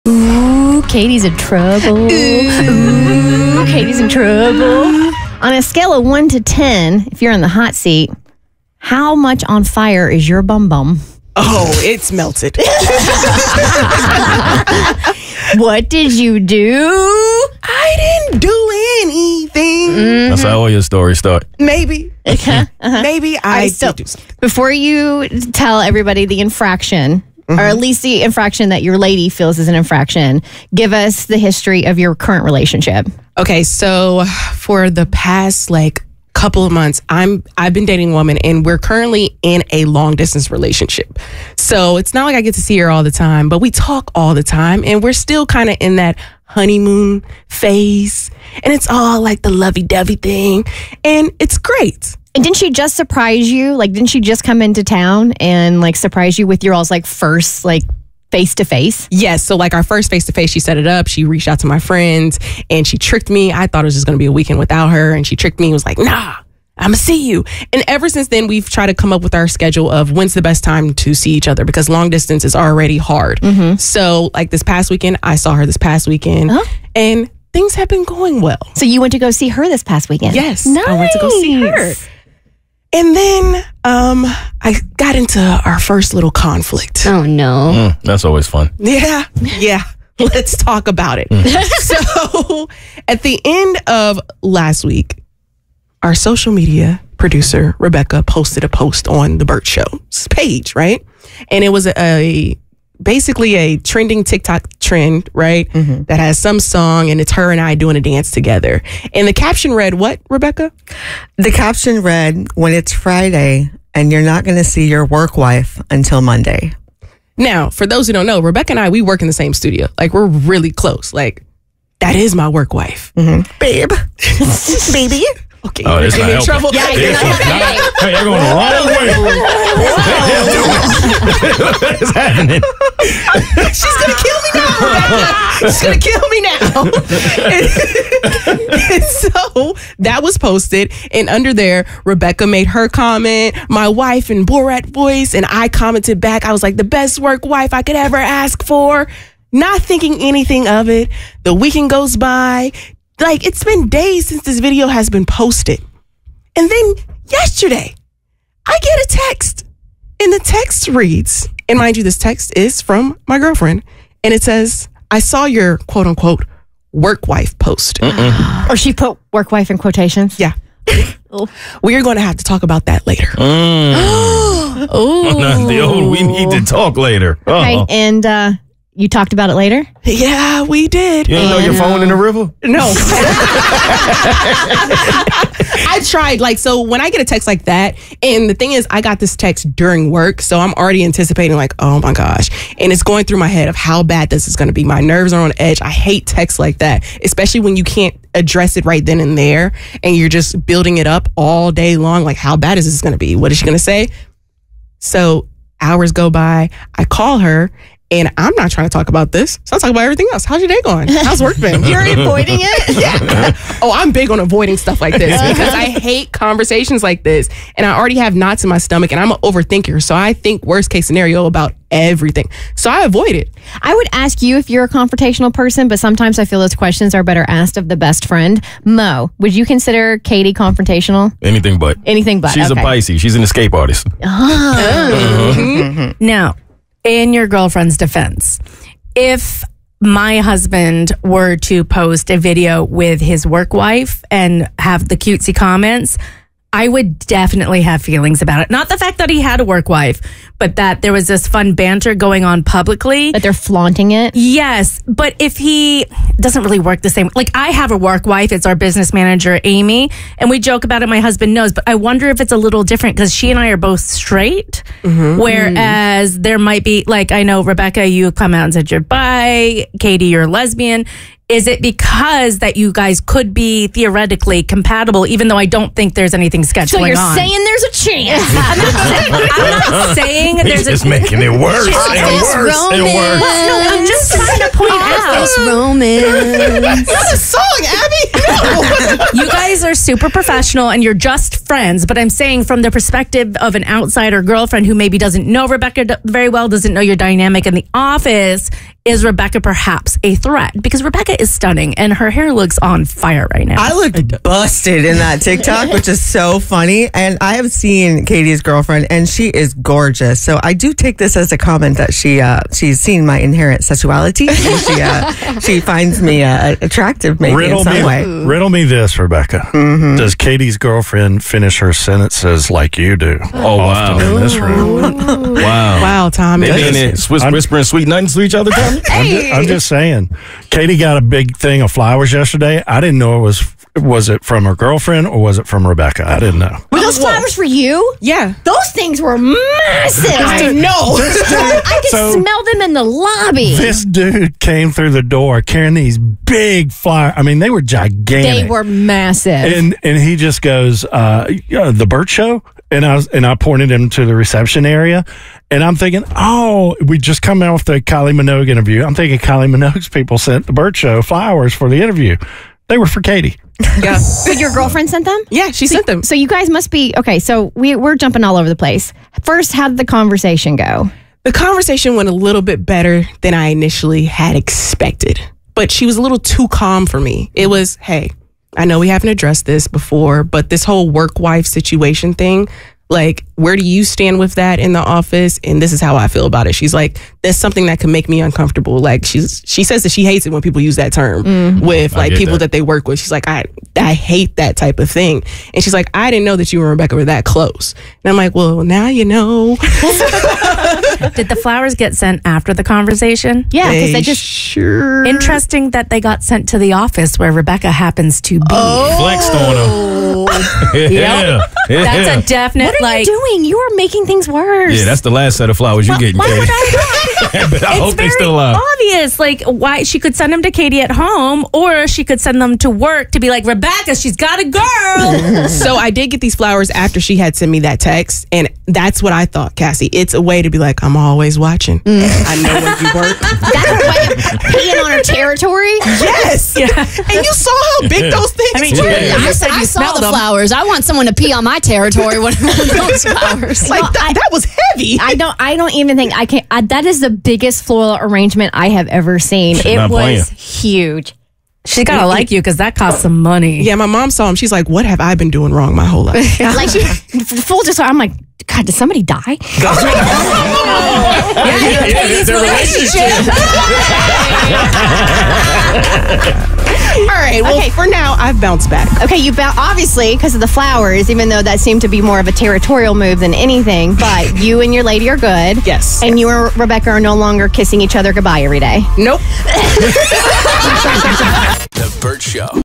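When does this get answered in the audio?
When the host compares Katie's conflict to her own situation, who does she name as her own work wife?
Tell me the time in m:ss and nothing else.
4:19.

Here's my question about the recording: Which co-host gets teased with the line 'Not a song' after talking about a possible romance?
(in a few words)
Abby.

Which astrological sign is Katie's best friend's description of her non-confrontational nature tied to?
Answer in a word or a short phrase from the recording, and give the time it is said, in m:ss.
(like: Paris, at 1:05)
Pisces, at 3:52.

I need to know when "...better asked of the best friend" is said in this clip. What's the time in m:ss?
3:47.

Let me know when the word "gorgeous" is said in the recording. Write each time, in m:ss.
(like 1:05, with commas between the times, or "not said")
5:09.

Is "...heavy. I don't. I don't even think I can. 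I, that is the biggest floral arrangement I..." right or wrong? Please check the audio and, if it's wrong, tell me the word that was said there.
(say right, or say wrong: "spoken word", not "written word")
right.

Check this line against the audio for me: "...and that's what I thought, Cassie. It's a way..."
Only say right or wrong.
right.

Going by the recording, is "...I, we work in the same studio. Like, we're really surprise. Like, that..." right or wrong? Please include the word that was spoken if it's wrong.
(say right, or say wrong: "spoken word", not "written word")
wrong: "close", not "surprise".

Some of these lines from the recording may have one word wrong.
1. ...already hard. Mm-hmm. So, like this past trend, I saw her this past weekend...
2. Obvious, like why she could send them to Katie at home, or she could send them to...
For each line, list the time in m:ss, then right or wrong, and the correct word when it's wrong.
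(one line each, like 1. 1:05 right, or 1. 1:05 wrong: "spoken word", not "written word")
1. 1:12 wrong: "weekend", not "trend"
2. 6:58 right.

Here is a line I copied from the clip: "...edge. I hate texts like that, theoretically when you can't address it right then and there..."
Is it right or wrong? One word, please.
wrong.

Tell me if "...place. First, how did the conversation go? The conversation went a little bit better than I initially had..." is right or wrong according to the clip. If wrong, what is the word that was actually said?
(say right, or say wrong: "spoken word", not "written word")
right.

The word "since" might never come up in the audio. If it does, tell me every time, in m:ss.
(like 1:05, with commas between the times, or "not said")
1:08, 2:34.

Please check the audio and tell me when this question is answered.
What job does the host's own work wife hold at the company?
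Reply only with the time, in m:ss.
4:18.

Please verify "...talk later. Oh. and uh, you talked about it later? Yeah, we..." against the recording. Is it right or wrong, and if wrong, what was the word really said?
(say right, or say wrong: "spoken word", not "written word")
right.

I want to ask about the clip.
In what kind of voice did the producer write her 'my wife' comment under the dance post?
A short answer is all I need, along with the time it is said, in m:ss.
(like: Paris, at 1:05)
Borat voice, at 2:24.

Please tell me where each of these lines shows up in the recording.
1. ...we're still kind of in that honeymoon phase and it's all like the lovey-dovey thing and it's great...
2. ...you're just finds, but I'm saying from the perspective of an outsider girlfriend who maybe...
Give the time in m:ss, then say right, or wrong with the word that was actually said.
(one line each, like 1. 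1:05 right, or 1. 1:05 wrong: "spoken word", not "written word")
1. 0:45 right
2. 4:51 wrong: "friends", not "finds".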